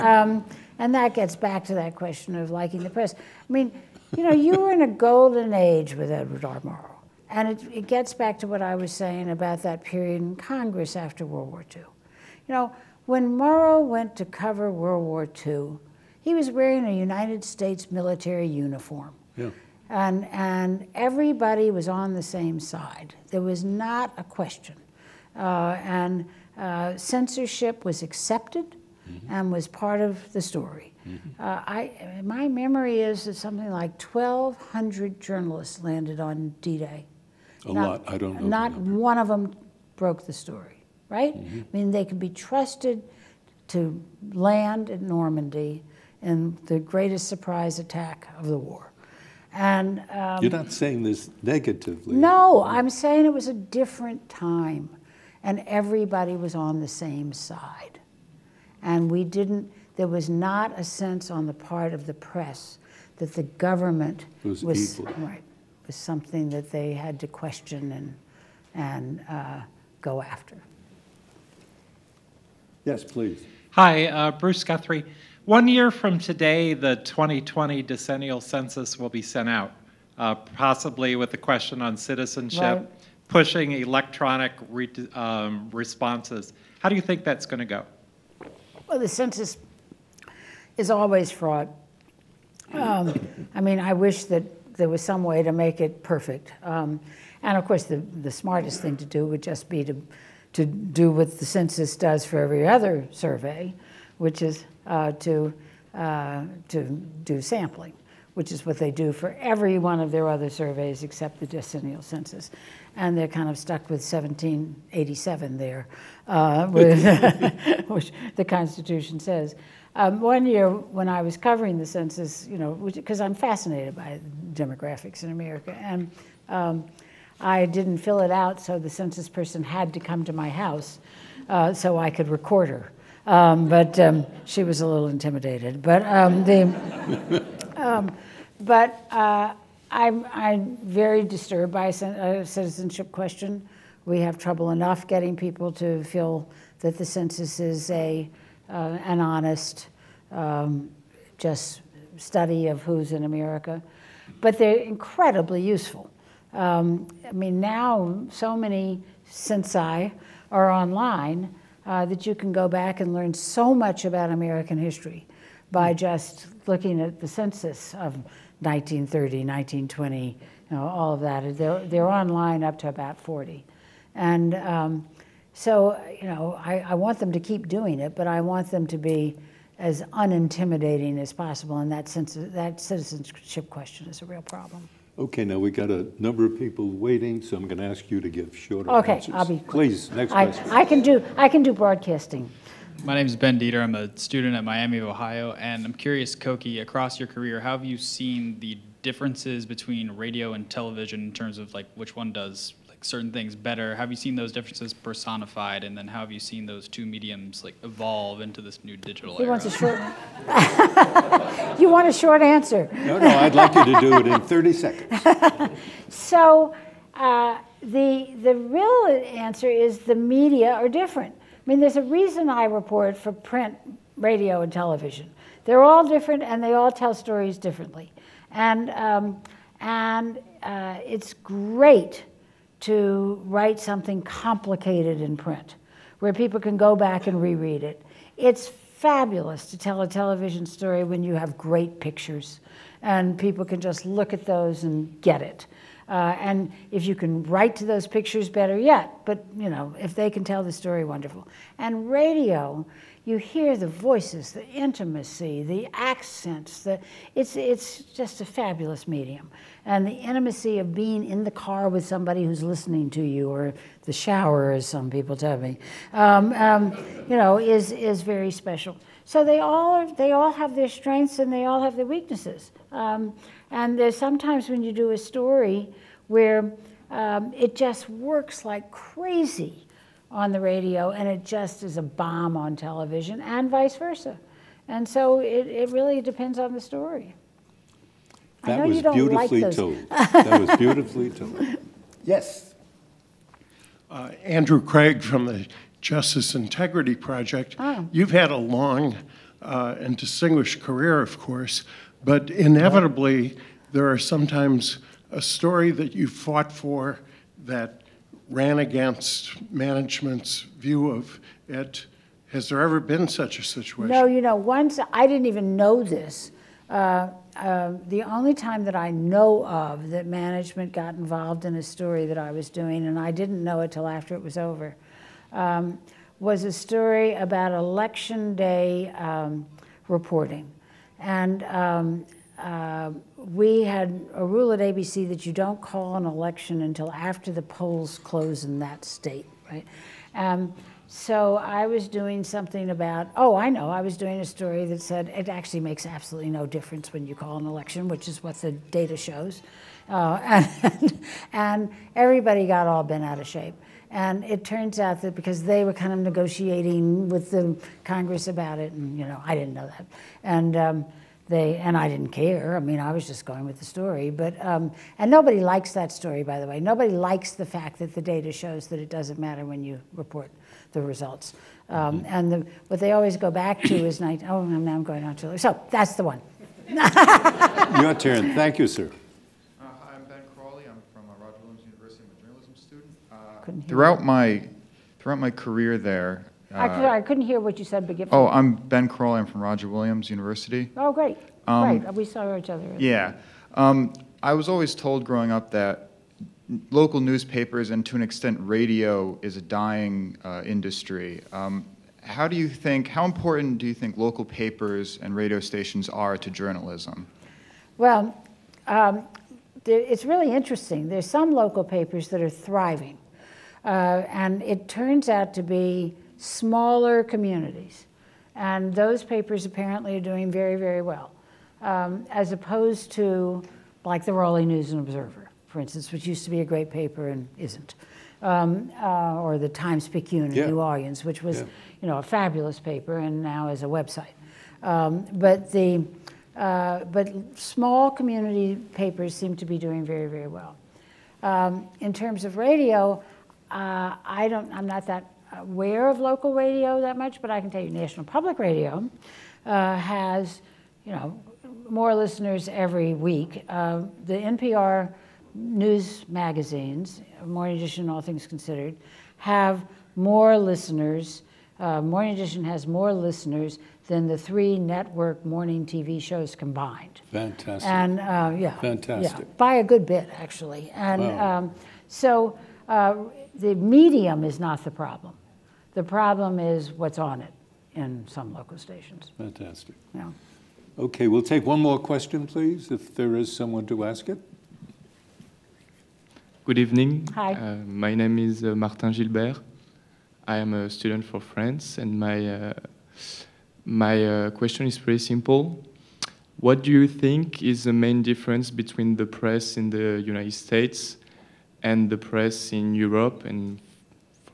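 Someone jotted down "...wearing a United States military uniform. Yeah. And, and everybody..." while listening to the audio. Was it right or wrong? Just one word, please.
right.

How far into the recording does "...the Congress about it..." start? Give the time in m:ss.
5:57.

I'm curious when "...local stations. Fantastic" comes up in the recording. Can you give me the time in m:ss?
7:58.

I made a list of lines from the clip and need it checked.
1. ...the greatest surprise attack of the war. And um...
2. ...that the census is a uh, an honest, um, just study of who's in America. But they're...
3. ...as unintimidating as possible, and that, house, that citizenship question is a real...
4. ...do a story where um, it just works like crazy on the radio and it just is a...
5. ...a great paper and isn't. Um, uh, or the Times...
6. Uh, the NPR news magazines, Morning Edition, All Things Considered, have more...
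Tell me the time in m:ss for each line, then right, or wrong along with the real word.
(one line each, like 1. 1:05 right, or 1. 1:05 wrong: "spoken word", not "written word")
1. 0:46 right
2. 2:26 right
3. 2:59 wrong: "sense", not "house"
4. 4:34 right
5. 7:06 right
6. 7:33 right.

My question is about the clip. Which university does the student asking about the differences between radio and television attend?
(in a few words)
Miami of Ohio.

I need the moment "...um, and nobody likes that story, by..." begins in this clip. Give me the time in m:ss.
6:04.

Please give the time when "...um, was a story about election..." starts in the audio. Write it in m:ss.
5:25.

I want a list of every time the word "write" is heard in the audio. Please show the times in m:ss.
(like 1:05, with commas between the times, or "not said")
3:53, 4:07.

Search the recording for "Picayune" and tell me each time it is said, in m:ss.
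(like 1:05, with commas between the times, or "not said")
7:10.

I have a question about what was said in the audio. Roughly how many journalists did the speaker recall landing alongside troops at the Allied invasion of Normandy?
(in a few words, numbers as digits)
1,200.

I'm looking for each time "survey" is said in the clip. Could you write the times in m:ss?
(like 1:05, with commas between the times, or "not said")
1:43, 1:50.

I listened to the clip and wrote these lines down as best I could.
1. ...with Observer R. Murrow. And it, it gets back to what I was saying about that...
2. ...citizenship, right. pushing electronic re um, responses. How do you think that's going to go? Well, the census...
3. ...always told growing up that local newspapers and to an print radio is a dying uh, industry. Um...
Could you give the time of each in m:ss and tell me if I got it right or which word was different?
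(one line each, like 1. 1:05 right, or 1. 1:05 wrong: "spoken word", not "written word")
1. 0:05 wrong: "Edward", not "Observer"
2. 1:21 right
3. 6:34 wrong: "extent", not "print".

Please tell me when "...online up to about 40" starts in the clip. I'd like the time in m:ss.
2:52.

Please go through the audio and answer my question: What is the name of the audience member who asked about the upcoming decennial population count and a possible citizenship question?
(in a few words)
Bruce Guthrie.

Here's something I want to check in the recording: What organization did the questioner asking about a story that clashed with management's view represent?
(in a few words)
Justice Integrity Project.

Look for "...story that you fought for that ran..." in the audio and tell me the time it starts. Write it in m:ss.
5:05.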